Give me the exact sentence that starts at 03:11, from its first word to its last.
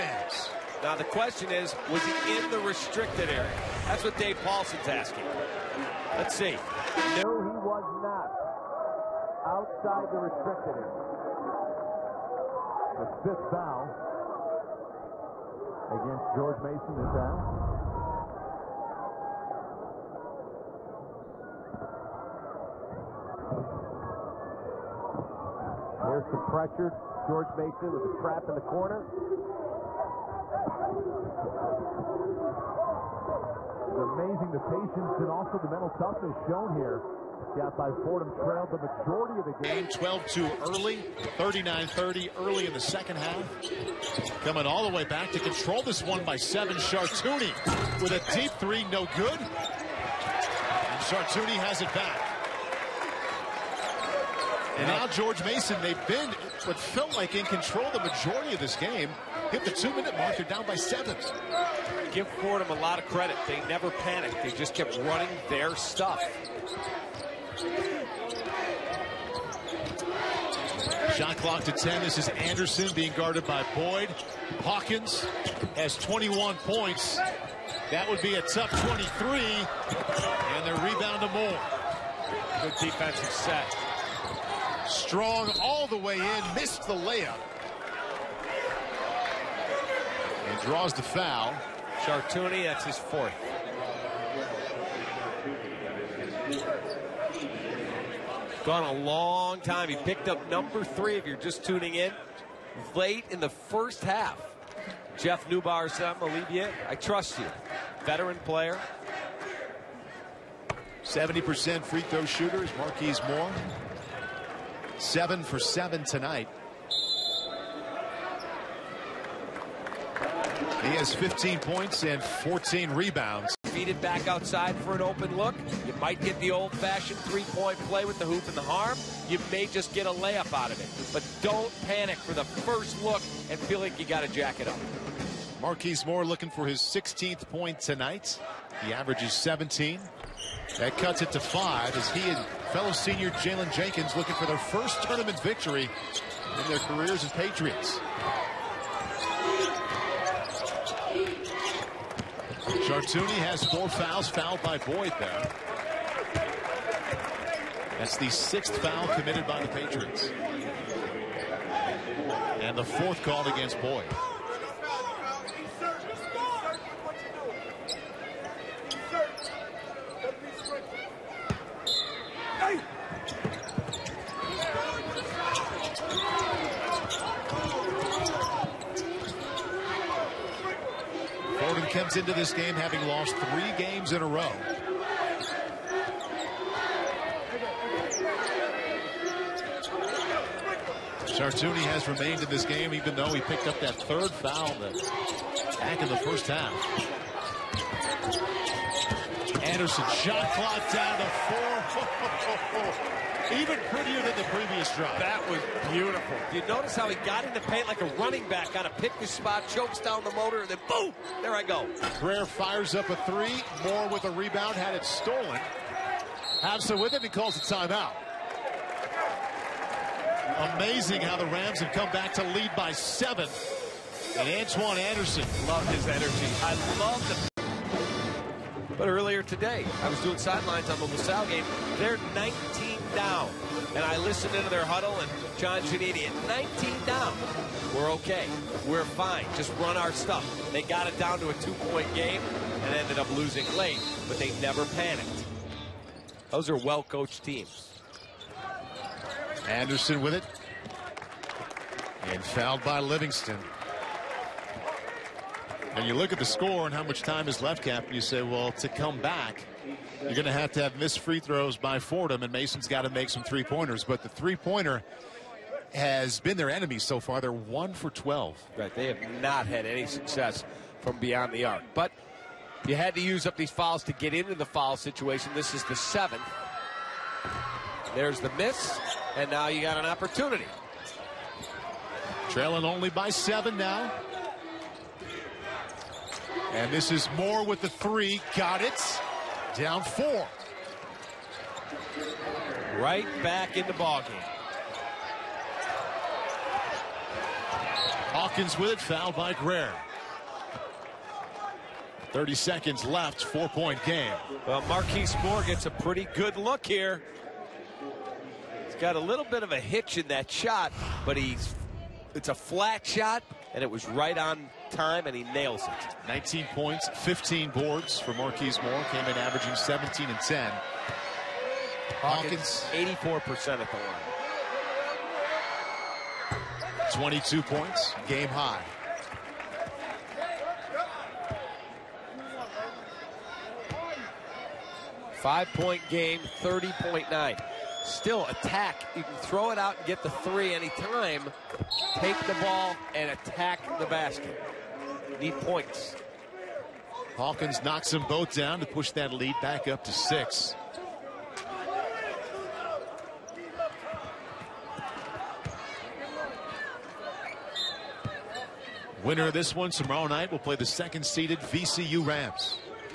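Chartouni has remained in this game even though he picked up that third foul back in the first half.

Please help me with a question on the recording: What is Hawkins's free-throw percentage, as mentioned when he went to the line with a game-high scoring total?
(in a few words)
84%.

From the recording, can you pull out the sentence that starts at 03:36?
Habsa with it and calls a timeout.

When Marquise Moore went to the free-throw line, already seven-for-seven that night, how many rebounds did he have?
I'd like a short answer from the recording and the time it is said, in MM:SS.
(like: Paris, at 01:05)
14, at 02:02.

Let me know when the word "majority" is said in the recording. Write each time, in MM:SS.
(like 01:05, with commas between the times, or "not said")
00:38, 00:57.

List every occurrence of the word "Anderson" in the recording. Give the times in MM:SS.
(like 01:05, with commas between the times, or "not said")
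01:12, 03:19, 03:44, 04:09.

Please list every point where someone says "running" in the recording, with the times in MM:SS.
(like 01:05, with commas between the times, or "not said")
01:04, 03:28.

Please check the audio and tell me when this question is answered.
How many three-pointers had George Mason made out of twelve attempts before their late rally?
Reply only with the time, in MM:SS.
04:27.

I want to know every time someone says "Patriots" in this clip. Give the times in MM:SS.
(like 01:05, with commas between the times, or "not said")
02:27, 02:39.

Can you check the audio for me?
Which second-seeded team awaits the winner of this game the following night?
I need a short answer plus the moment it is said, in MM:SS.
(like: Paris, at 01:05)
VCU Rams, at 06:01.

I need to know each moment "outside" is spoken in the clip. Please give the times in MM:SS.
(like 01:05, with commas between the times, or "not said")
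00:09, 02:04.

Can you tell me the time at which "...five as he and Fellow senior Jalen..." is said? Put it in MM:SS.
02:21.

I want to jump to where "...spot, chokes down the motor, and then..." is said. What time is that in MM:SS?
03:29.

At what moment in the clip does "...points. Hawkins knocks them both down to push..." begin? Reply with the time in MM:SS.
05:45.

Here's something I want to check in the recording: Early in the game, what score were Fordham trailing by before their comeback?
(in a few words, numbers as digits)
12-2.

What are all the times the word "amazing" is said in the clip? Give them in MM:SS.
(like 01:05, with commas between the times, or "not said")
00:34, 03:40.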